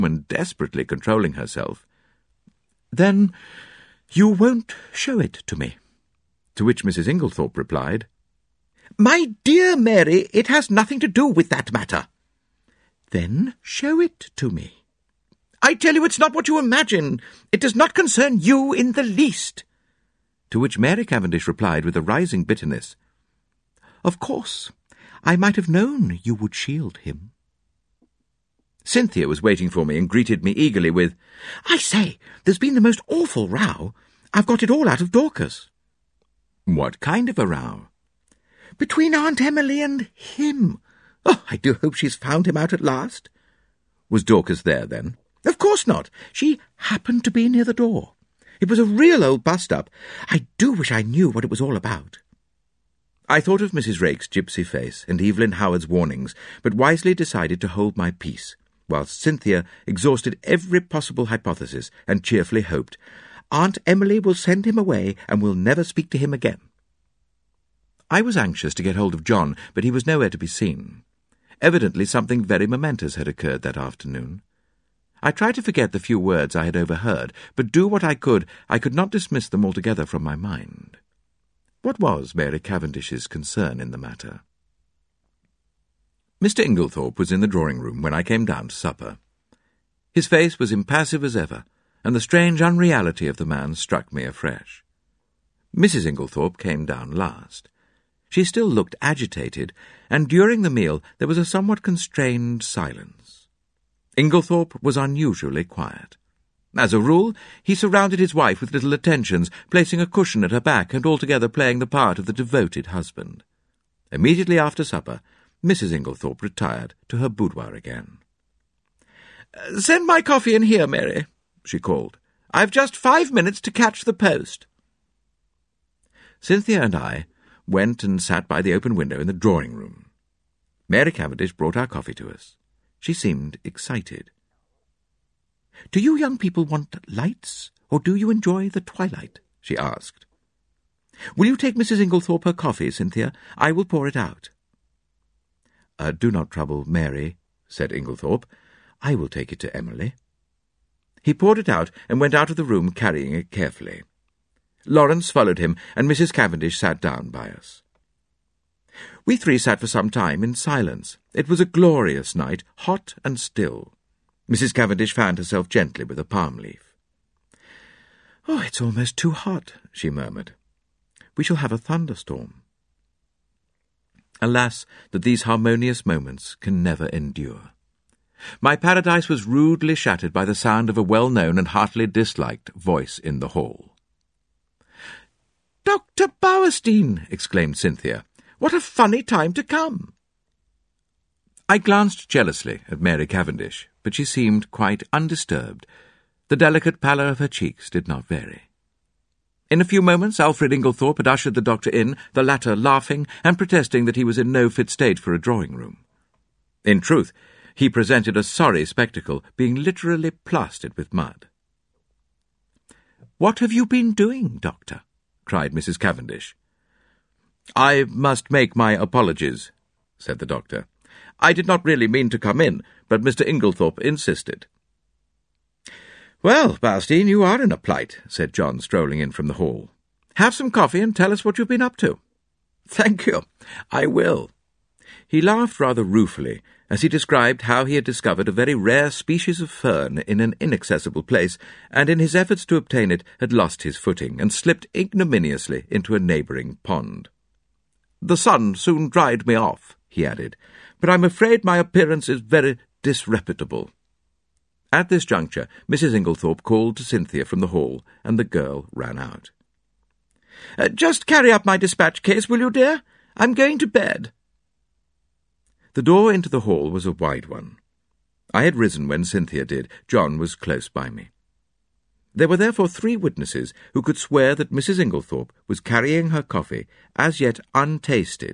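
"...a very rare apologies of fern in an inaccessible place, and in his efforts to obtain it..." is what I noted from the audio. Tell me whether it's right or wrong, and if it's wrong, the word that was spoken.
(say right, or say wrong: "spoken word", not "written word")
wrong: "species", not "apologies".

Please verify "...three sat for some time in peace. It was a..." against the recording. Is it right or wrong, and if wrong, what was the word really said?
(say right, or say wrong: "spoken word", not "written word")
wrong: "silence", not "peace".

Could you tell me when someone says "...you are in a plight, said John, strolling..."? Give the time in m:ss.
3:47.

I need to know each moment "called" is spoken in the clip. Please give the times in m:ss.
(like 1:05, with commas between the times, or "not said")
2:01, 4:16.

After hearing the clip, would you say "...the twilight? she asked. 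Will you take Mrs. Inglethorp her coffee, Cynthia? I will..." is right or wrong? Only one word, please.
right.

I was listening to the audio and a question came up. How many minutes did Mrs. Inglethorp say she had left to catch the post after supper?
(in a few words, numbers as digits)
5.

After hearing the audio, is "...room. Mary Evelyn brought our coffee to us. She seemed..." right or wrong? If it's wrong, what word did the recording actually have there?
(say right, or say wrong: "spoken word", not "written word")
wrong: "Cavendish", not "Evelyn".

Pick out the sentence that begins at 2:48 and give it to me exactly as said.
Oh, it's almost too hot, she murmured.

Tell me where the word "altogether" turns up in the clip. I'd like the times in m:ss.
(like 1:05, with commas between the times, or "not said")
1:19, 1:51.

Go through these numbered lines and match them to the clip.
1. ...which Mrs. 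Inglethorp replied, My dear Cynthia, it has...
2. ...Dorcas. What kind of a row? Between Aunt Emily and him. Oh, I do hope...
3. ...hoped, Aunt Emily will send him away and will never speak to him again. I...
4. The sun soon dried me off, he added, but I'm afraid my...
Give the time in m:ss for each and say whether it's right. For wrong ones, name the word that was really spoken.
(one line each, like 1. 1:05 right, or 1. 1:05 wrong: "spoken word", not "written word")
1. 0:06 wrong: "Mary", not "Cynthia"
2. 0:35 right
3. 1:02 right
4. 4:08 right.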